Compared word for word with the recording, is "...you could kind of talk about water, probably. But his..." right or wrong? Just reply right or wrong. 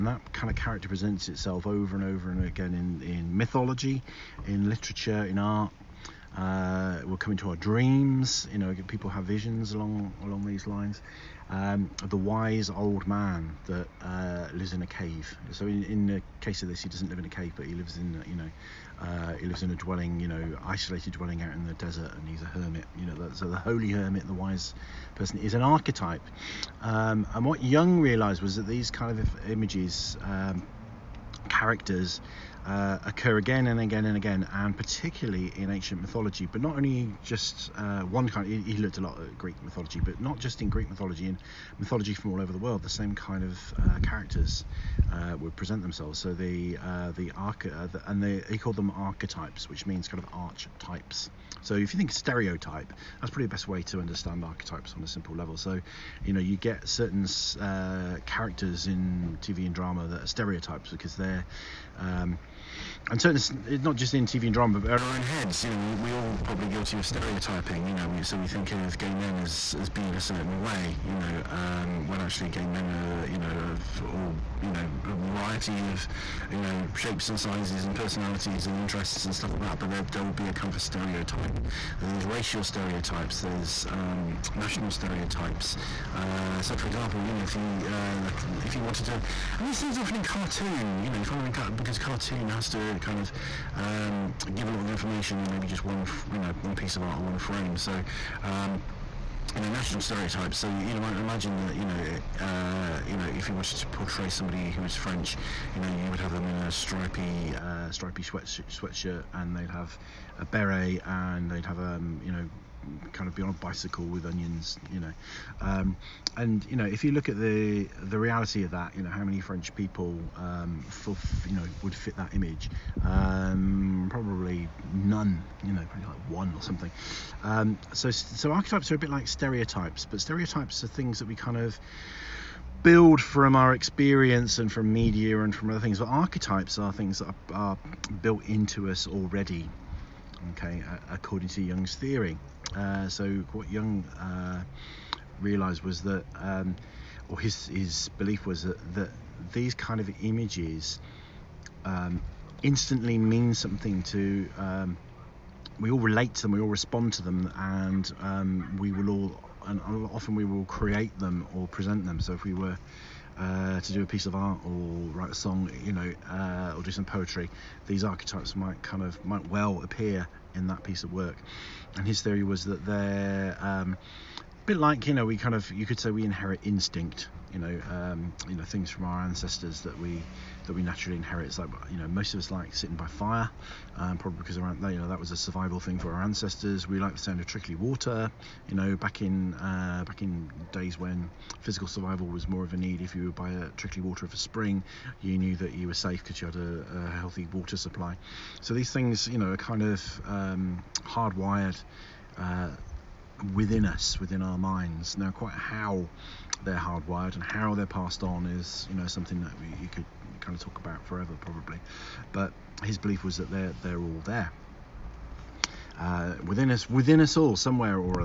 wrong.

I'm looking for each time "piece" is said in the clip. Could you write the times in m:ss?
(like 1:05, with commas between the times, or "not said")
1:36, 2:44, 2:50.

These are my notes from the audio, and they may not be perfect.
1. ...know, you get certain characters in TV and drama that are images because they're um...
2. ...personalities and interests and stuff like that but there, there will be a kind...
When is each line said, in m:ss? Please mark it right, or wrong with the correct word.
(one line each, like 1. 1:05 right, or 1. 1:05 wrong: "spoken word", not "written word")
1. 0:56 wrong: "stereotypes", not "images"
2. 1:17 right.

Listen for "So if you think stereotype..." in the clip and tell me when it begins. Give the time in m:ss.
0:51.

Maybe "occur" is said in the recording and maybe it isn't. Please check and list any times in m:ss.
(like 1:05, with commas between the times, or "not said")
0:33.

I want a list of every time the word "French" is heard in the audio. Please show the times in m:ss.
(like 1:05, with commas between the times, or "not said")
1:44, 1:59.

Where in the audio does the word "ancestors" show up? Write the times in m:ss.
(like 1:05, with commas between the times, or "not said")
2:59, 3:06.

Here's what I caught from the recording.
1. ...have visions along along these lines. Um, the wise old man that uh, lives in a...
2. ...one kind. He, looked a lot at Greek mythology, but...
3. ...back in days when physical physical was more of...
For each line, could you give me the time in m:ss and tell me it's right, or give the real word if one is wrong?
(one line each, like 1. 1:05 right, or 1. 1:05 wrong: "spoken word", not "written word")
1. 0:09 right
2. 0:38 right
3. 3:10 wrong: "survival", not "physical".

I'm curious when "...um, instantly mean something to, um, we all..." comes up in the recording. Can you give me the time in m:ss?
2:31.